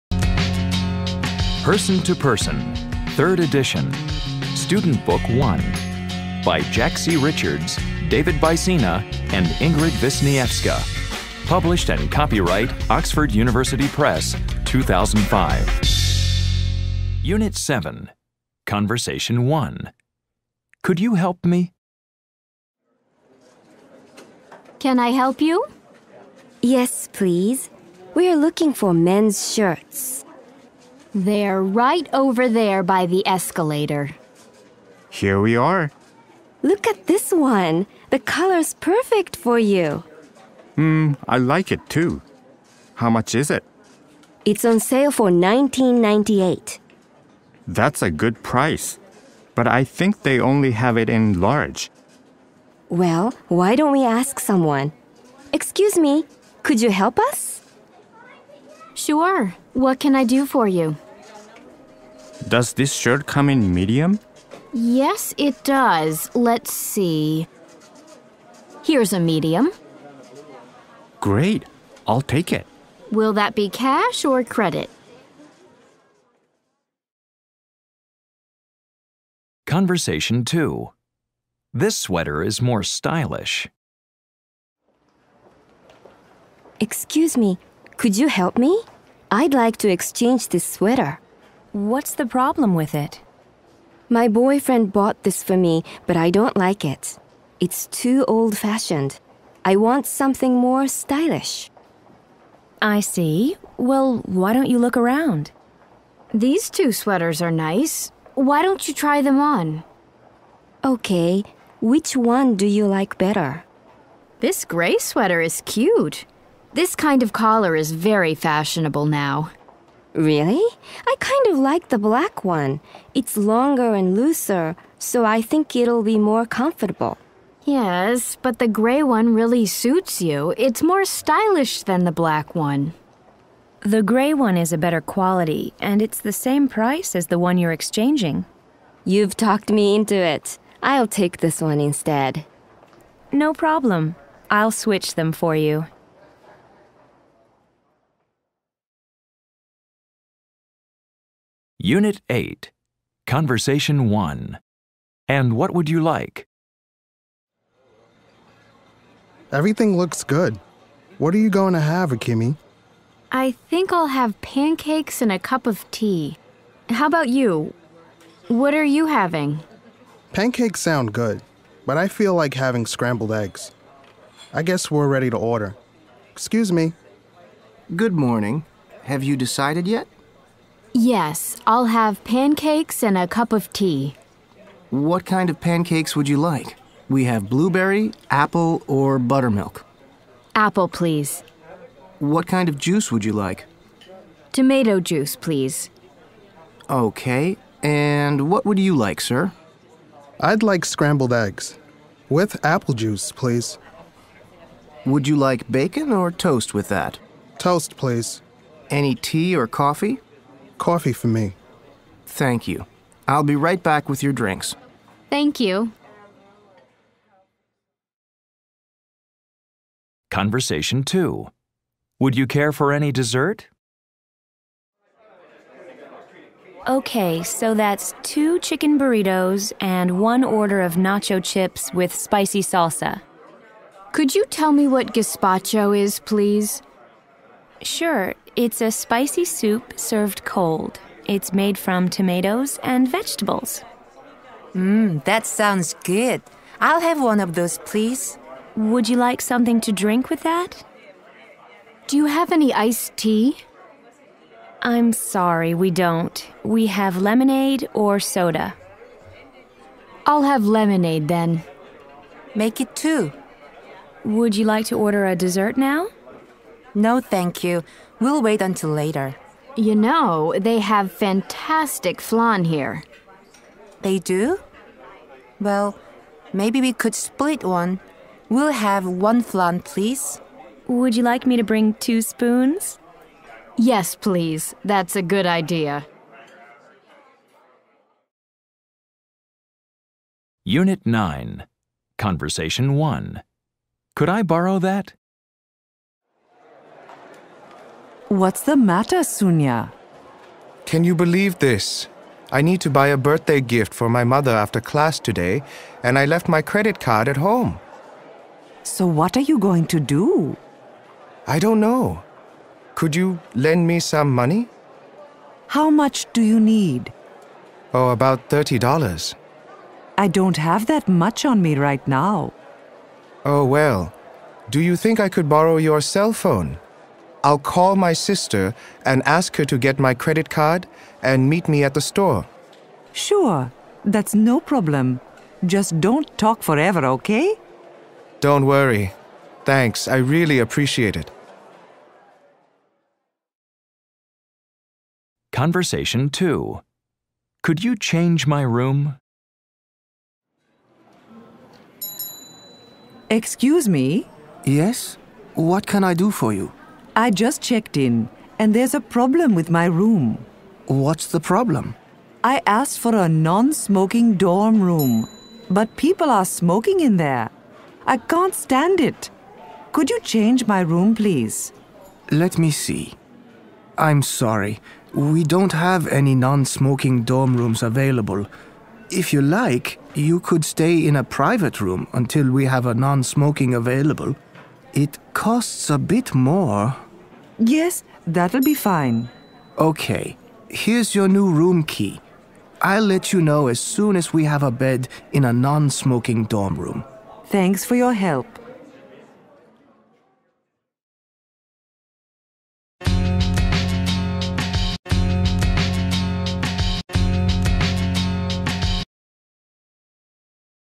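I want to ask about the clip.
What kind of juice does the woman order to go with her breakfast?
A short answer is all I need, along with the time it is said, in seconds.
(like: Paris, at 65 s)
Tomato juice, at 194 s.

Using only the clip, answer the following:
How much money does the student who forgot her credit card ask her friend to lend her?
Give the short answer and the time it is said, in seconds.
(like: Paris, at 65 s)
$30, at 318 s.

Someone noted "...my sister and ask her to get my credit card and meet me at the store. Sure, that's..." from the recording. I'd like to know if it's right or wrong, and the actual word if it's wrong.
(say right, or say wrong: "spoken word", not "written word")
right.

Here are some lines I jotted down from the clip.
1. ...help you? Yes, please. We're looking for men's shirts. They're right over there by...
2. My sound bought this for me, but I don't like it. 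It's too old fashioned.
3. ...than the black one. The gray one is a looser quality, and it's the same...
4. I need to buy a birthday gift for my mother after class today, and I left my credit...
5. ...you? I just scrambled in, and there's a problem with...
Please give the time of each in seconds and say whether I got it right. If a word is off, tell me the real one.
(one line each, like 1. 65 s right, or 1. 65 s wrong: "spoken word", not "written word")
1. 25 s right
2. 94 s wrong: "boyfriend", not "sound"
3. 131 s wrong: "better", not "looser"
4. 302 s right
5. 356 s wrong: "checked", not "scrambled".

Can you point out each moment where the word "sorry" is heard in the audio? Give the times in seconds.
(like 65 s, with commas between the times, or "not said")
255 s, 374 s.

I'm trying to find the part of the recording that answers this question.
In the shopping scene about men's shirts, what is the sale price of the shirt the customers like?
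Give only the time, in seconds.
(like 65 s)
45 s.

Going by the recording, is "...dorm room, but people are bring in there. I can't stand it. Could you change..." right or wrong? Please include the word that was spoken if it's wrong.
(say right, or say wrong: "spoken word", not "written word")
wrong: "smoking", not "bring".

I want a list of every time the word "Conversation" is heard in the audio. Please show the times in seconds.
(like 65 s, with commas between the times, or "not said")
18 s, 79 s, 153 s, 220 s, 292 s, 345 s.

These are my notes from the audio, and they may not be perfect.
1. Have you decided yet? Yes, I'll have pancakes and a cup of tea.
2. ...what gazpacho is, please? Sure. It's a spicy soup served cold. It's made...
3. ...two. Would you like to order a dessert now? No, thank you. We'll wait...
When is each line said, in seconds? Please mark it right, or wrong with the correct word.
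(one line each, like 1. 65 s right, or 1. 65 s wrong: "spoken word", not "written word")
1. 179 s right
2. 234 s right
3. 262 s right.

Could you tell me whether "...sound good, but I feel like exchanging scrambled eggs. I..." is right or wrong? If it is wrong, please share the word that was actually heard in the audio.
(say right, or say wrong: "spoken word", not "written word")
wrong: "having", not "exchanging".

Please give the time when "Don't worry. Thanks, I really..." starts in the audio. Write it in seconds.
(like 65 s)
338 s.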